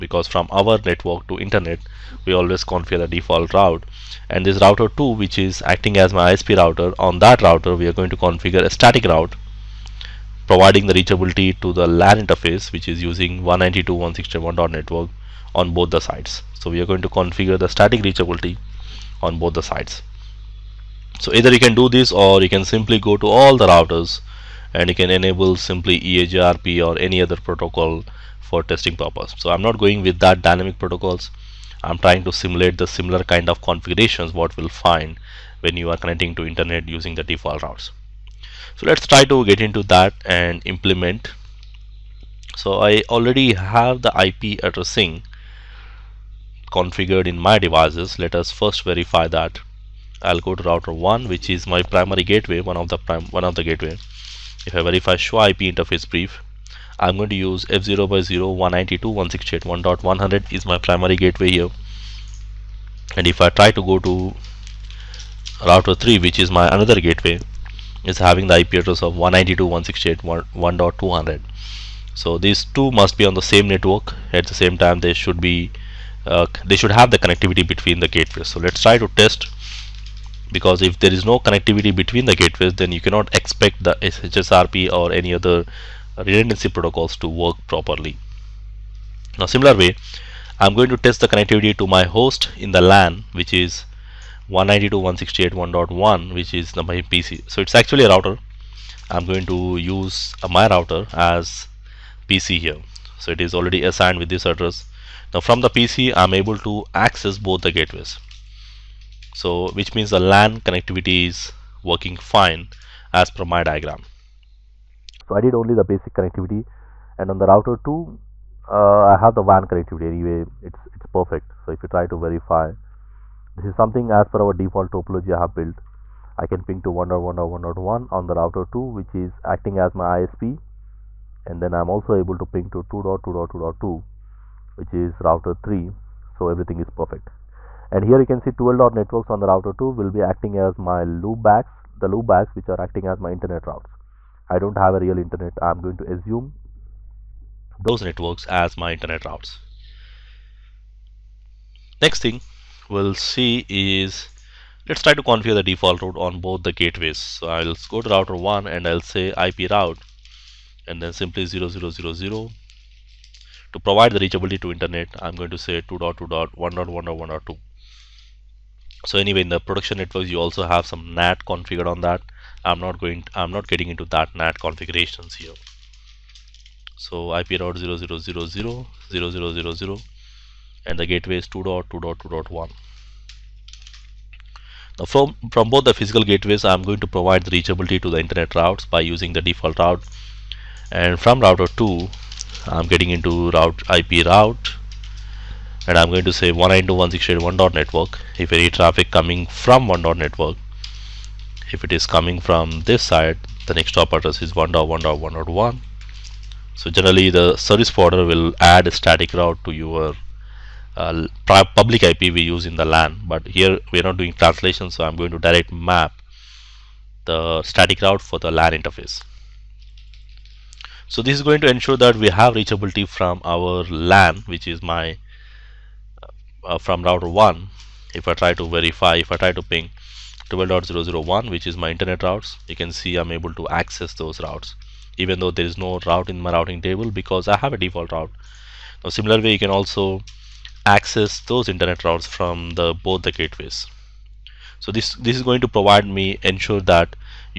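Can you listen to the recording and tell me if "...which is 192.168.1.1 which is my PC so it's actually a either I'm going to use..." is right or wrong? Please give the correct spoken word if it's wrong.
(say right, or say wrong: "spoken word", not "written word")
wrong: "router", not "either".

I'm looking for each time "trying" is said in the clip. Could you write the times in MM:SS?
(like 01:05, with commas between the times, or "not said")
00:31.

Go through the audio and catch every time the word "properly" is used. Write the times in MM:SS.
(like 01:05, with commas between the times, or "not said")
01:27.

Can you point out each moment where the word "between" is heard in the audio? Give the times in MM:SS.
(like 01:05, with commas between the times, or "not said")
01:17, 01:21.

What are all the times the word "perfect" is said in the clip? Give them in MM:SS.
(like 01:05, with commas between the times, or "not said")
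02:01, 02:17.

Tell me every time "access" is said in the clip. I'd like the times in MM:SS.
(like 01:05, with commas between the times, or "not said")
01:46, 03:53, 04:00.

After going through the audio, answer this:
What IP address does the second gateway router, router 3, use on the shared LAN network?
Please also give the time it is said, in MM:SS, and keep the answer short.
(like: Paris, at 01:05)
192.168.1.200, at 01:09.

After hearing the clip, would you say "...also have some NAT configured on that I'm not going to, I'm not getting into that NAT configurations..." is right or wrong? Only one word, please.
right.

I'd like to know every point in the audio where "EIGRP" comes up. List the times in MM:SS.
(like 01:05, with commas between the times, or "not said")
00:25.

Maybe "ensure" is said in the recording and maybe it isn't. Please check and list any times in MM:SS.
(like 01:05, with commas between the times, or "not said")
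03:41, 04:06.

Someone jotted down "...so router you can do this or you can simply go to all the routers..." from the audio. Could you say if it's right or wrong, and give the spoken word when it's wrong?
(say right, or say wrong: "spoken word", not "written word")
wrong: "either", not "router".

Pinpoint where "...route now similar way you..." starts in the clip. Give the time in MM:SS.
03:58.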